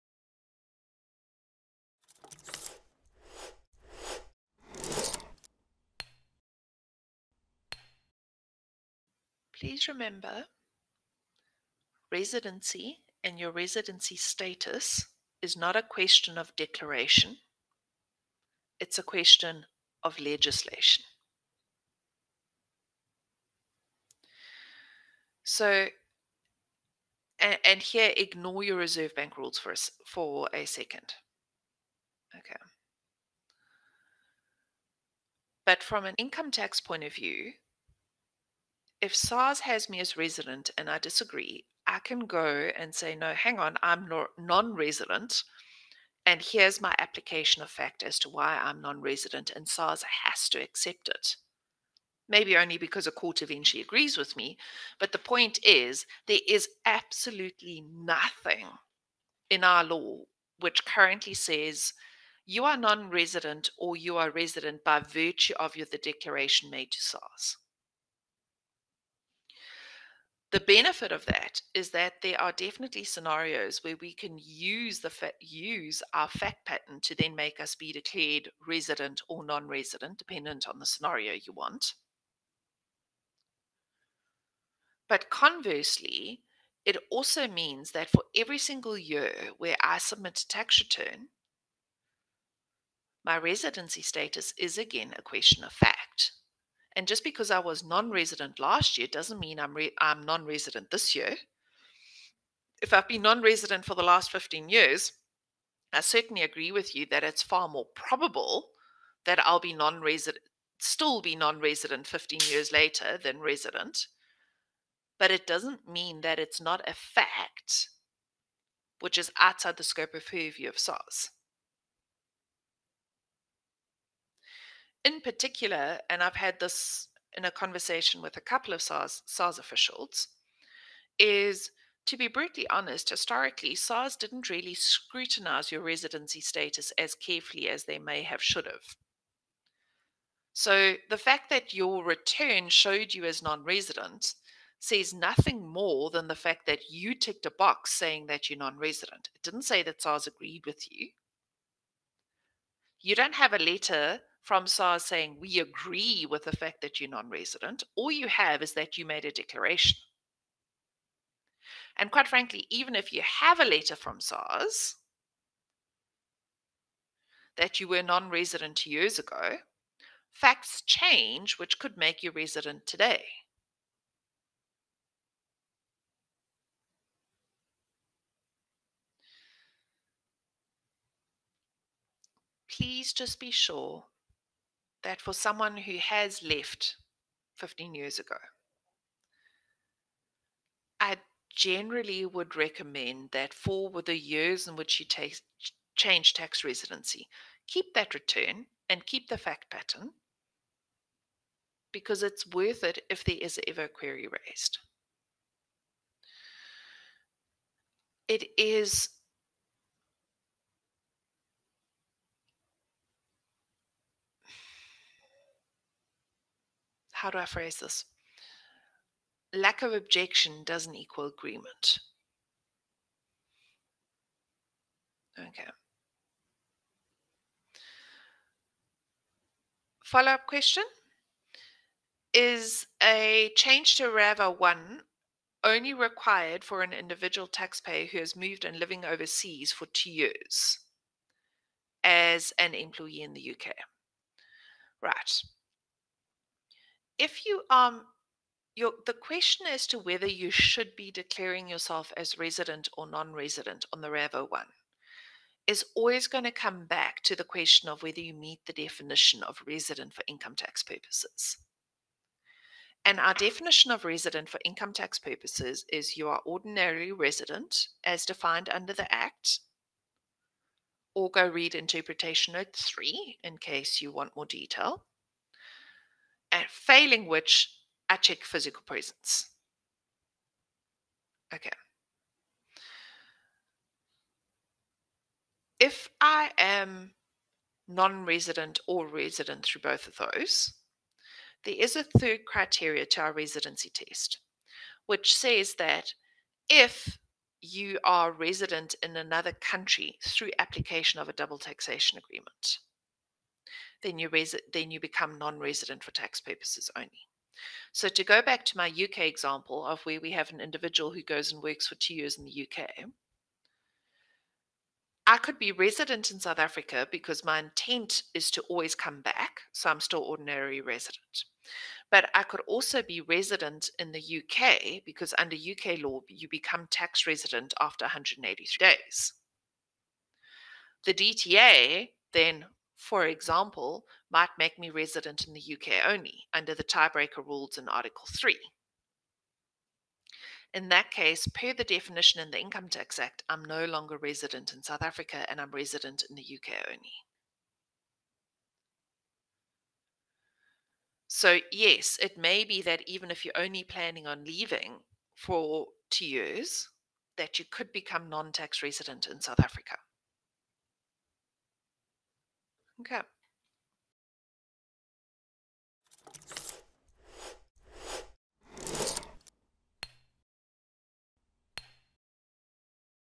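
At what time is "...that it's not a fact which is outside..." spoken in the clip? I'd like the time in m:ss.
1:56.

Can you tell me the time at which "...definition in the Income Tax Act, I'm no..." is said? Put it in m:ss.
5:41.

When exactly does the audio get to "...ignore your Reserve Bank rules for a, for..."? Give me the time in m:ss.
0:28.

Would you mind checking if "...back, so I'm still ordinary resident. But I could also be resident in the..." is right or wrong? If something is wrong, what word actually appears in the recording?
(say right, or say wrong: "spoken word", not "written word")
right.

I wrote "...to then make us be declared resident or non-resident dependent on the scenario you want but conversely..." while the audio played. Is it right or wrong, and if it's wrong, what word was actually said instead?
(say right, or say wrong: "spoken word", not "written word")
right.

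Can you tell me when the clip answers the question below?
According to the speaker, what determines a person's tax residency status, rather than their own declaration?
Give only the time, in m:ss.
0:20.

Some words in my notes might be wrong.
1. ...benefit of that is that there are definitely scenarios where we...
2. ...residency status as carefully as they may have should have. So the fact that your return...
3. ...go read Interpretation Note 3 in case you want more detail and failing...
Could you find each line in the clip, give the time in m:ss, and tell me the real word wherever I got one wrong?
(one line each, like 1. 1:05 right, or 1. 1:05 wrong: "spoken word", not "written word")
1. 1:10 right
2. 2:15 right
3. 4:31 right.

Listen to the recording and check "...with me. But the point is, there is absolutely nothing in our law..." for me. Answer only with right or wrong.
right.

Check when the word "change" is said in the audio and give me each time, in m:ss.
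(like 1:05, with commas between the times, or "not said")
2:50, 3:15, 3:53.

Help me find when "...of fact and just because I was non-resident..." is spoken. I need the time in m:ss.
1:35.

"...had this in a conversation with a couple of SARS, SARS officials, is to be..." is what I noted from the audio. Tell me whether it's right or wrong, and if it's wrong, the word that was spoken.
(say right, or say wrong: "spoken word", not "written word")
right.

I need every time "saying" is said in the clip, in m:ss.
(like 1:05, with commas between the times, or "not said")
2:27, 2:35.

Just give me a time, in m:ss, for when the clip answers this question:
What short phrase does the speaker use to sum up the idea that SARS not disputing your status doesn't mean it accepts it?
3:39.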